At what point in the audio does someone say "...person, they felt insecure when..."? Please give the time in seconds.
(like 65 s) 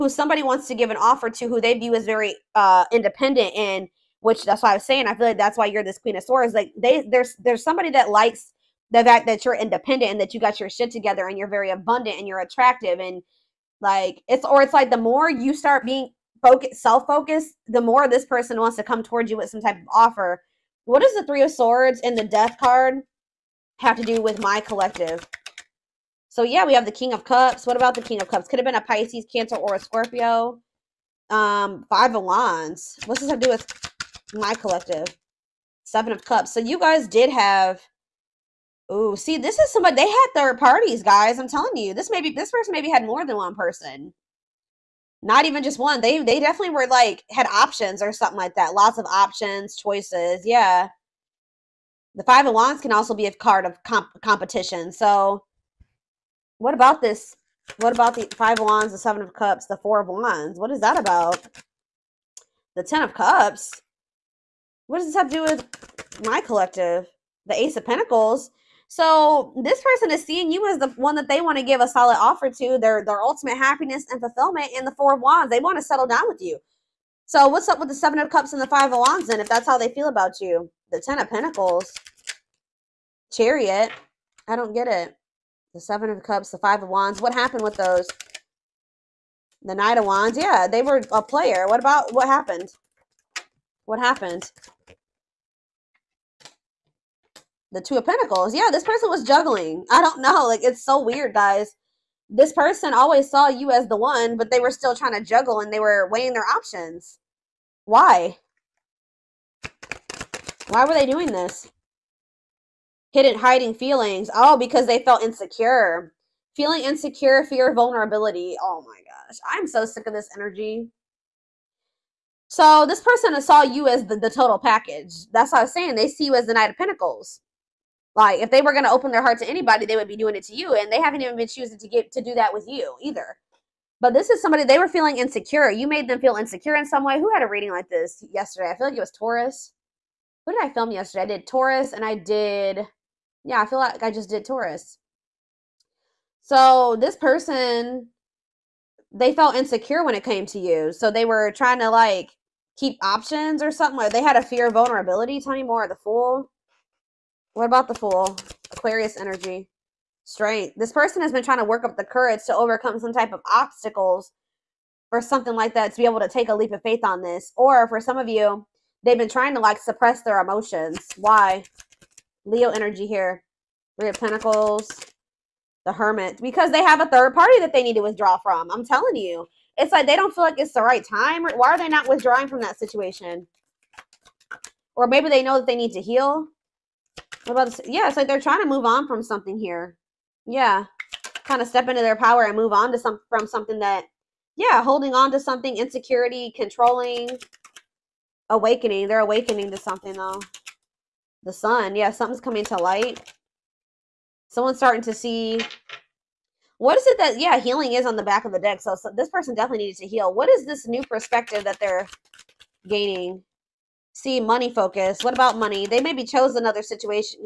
147 s.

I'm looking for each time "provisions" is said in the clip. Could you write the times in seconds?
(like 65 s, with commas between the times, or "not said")
not said.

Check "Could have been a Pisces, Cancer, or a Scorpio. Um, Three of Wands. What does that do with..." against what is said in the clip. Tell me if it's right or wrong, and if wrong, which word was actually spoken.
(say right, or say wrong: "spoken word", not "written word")
wrong: "Five", not "Three".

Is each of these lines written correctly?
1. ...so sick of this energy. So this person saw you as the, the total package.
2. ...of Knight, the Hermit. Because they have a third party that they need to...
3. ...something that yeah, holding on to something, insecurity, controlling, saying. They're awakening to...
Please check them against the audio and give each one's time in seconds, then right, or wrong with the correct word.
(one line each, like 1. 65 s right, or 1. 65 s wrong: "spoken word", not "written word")
1. 119 s right
2. 174 s wrong: "Pentacles", not "Knight"
3. 193 s wrong: "awakening", not "saying".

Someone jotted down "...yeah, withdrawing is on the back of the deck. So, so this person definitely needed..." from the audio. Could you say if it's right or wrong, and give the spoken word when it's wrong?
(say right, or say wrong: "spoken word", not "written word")
wrong: "healing", not "withdrawing".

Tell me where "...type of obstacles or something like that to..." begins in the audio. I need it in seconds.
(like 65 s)
163 s.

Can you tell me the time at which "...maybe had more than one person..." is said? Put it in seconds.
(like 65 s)
42 s.